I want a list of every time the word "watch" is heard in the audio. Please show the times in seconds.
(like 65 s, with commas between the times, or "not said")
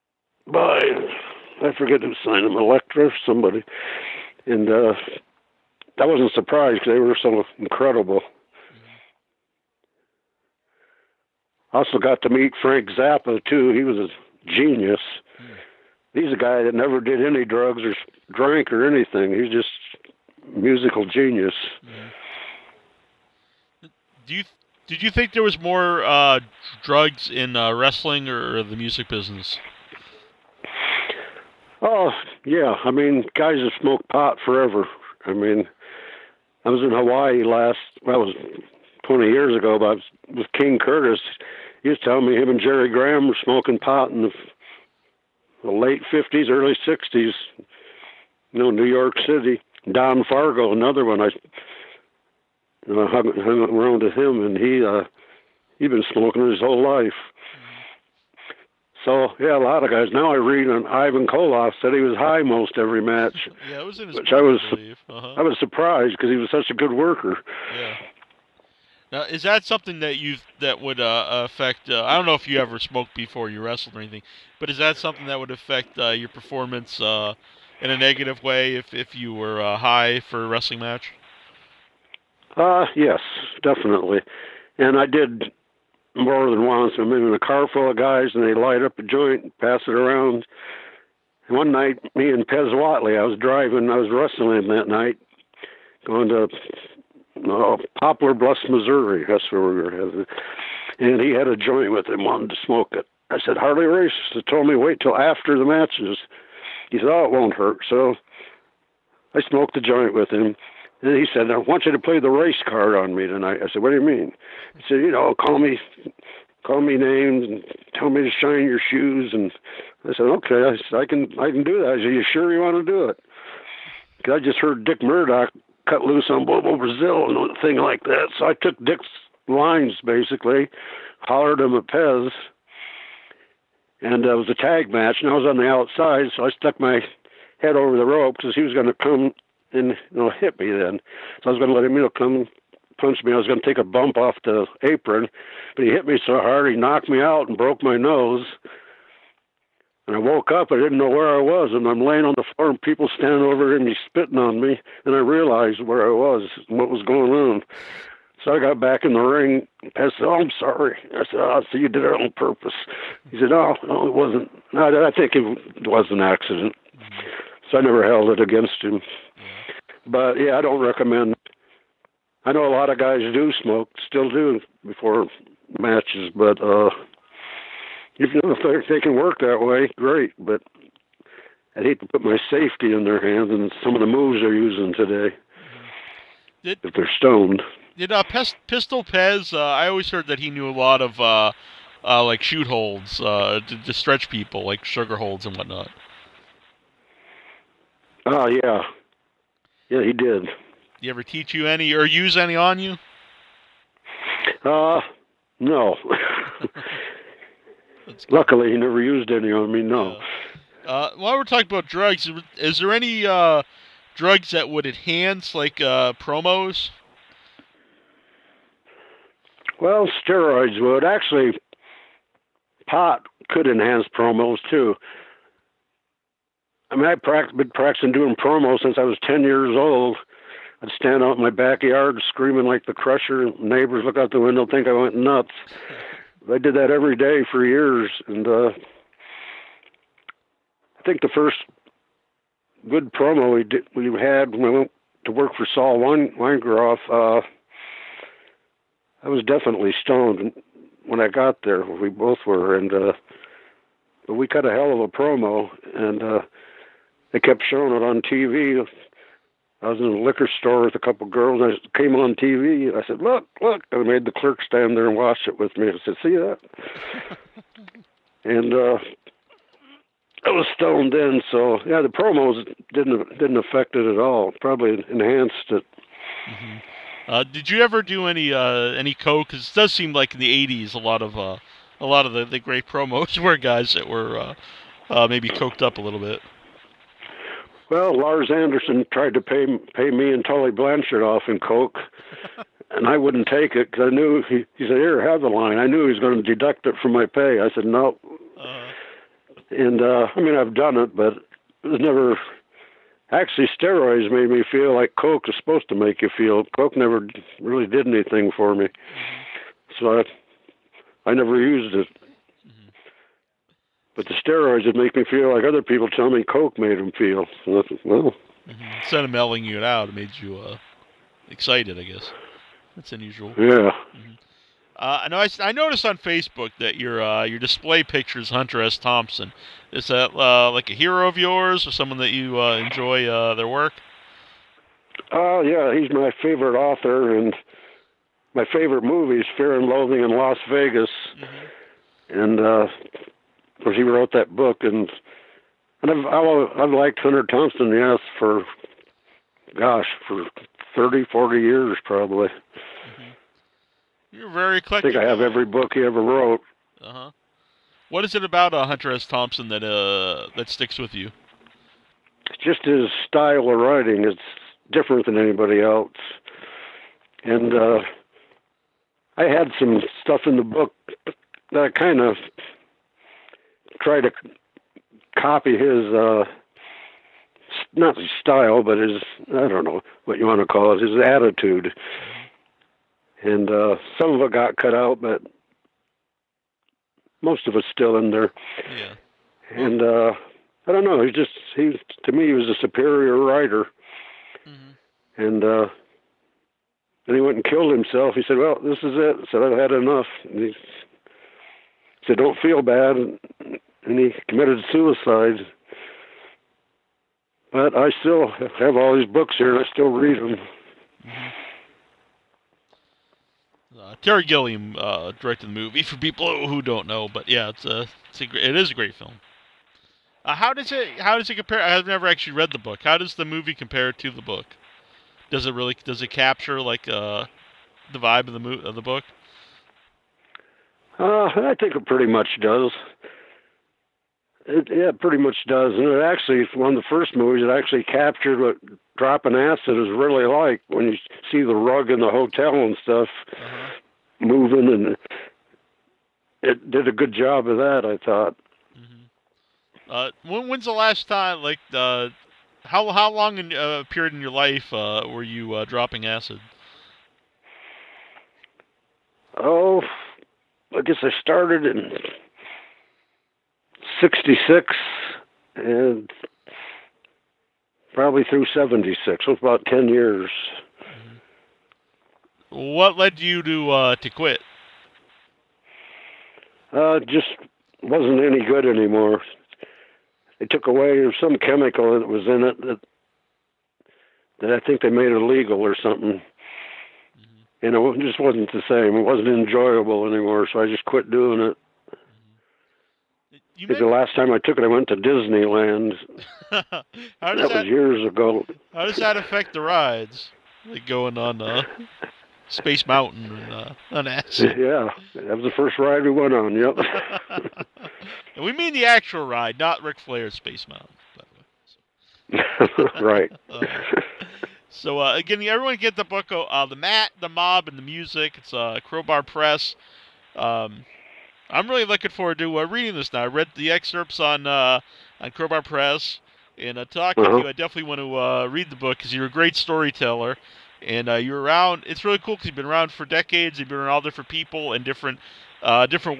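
265 s.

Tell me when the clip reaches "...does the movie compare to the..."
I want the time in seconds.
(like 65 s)
423 s.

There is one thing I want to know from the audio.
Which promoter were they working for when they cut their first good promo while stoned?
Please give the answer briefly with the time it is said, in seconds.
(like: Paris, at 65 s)
Saul Weingeroff, at 245 s.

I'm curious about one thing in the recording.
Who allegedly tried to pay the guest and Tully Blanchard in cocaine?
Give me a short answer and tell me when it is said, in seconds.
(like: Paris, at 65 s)
Lars Anderson, at 288 s.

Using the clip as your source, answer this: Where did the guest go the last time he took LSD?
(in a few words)
Disneyland.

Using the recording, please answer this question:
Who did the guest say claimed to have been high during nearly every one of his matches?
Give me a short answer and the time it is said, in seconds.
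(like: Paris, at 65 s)
Ivan Koloff, at 60 s.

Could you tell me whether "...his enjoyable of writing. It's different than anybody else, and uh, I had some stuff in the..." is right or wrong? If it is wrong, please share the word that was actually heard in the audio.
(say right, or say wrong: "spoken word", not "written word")
wrong: "style", not "enjoyable".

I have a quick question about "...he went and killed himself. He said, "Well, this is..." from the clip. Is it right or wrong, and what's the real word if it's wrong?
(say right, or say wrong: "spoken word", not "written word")
right.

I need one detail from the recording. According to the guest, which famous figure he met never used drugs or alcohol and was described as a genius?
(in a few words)
Frank Zappa.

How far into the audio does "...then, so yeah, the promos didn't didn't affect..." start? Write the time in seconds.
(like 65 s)
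271 s.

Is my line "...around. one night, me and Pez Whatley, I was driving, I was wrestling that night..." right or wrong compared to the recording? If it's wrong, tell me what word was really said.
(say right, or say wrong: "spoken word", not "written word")
right.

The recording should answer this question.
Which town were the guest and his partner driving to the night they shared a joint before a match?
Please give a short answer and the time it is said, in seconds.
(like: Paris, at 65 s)
Poplar Bluffs, Missouri, at 97 s.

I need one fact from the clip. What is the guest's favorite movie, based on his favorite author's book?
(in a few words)
Fear and Loathing in Las Vegas.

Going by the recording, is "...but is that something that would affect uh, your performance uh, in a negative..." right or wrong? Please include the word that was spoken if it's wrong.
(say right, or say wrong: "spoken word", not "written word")
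right.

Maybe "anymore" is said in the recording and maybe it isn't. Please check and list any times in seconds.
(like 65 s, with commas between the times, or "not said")
478 s, 490 s.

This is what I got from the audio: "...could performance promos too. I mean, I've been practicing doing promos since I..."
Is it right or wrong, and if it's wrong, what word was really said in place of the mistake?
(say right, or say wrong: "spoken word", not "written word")
wrong: "enhance", not "performance".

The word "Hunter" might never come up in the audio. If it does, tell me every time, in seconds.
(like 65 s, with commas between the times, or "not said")
328 s, 347 s, 358 s.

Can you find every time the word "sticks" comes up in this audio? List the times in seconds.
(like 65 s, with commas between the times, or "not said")
360 s.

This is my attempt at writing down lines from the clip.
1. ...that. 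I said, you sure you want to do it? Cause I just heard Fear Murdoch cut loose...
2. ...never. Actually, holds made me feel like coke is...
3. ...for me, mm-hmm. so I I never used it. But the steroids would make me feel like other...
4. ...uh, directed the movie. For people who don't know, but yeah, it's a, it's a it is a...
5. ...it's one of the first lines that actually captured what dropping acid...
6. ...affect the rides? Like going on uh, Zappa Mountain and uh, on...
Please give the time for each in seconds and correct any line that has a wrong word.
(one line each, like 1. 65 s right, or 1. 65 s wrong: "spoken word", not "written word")
1. 121 s wrong: "Dick", not "Fear"
2. 302 s wrong: "steroids", not "holds"
3. 308 s right
4. 414 s right
5. 436 s wrong: "movies", not "lines"
6. 499 s wrong: "Space", not "Zappa".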